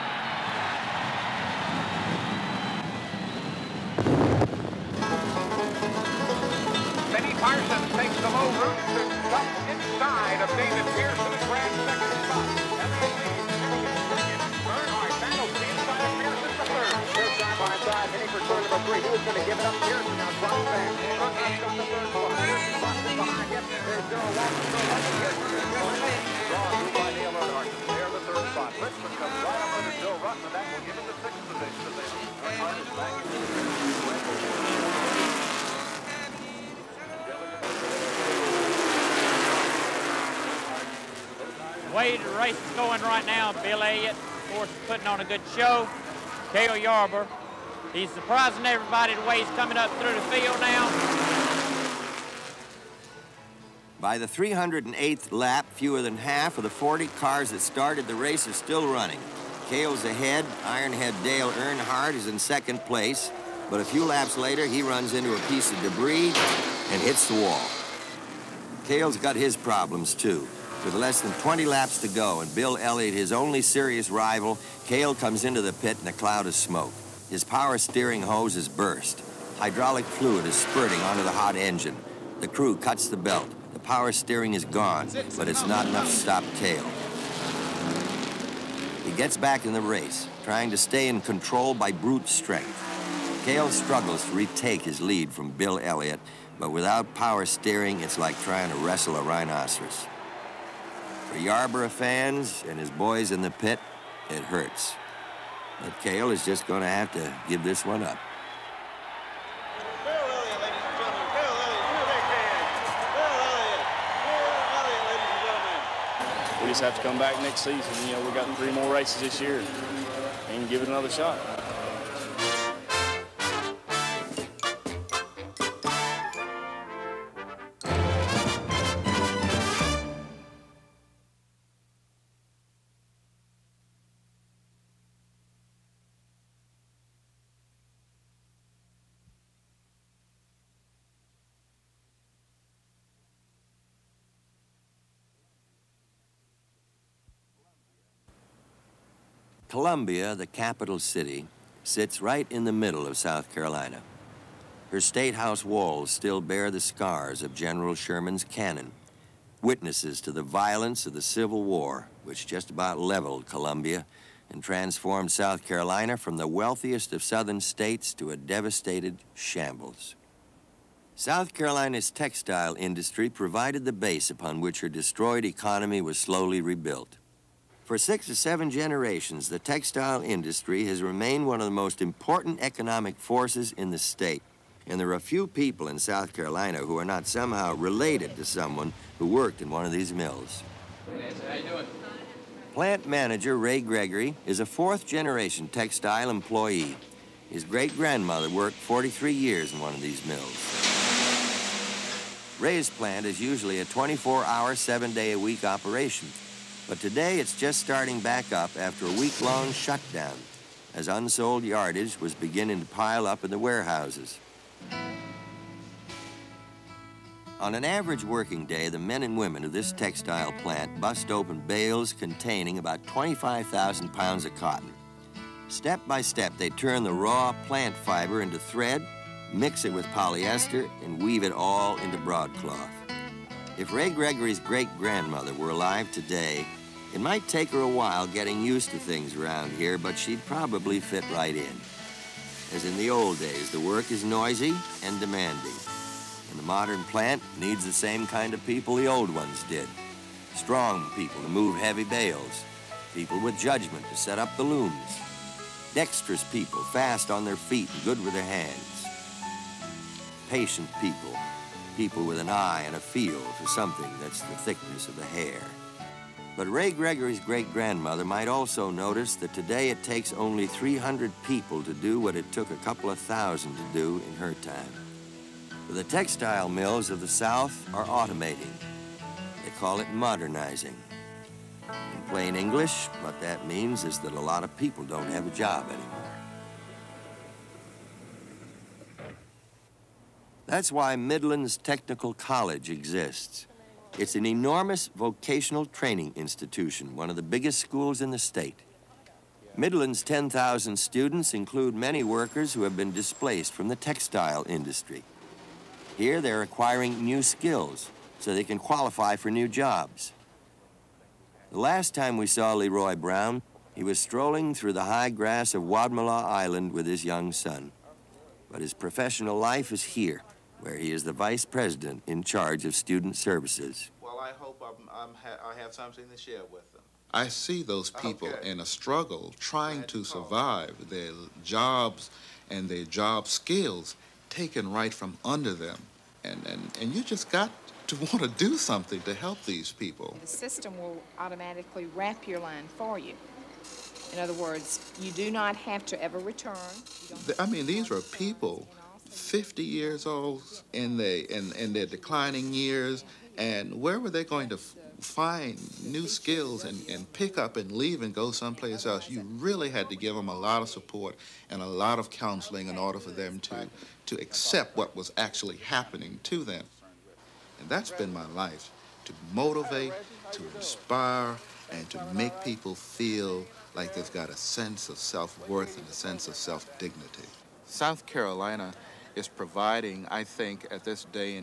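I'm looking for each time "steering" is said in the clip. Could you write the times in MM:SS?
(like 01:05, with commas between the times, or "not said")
01:17, 01:24, 01:37.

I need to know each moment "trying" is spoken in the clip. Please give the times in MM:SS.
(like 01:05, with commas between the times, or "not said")
01:30, 01:38, 05:29.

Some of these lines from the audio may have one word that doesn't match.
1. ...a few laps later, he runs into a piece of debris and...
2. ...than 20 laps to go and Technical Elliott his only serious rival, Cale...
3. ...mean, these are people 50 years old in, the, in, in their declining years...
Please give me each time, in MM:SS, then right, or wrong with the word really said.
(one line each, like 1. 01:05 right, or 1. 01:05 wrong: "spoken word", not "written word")
1. 01:03 right
2. 01:11 wrong: "Bill", not "Technical"
3. 05:47 right.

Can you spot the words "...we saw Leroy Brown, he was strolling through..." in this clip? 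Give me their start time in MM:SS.
05:12.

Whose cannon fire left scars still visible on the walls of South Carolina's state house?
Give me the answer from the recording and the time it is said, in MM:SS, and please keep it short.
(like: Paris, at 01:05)
General Sherman, at 02:37.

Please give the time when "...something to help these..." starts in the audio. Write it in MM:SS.
05:38.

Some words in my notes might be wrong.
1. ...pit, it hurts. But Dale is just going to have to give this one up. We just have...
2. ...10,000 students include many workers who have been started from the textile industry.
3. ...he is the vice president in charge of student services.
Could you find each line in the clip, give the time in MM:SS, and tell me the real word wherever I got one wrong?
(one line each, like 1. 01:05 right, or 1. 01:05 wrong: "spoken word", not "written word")
1. 01:43 wrong: "Cale", not "Dale"
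2. 05:00 wrong: "displaced", not "started"
3. 05:20 right.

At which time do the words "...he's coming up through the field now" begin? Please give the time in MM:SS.
00:49.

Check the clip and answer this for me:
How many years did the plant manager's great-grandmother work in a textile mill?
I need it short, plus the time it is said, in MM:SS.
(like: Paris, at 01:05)
43, at 03:18.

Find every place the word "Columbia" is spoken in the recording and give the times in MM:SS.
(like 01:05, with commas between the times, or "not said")
02:29, 02:43.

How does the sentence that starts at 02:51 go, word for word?
South Carolina's textile industry provided the base upon which her destroyed economy was slowly rebuilt.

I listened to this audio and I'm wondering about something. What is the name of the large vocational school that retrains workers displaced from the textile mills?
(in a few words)
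Midlands Technical College.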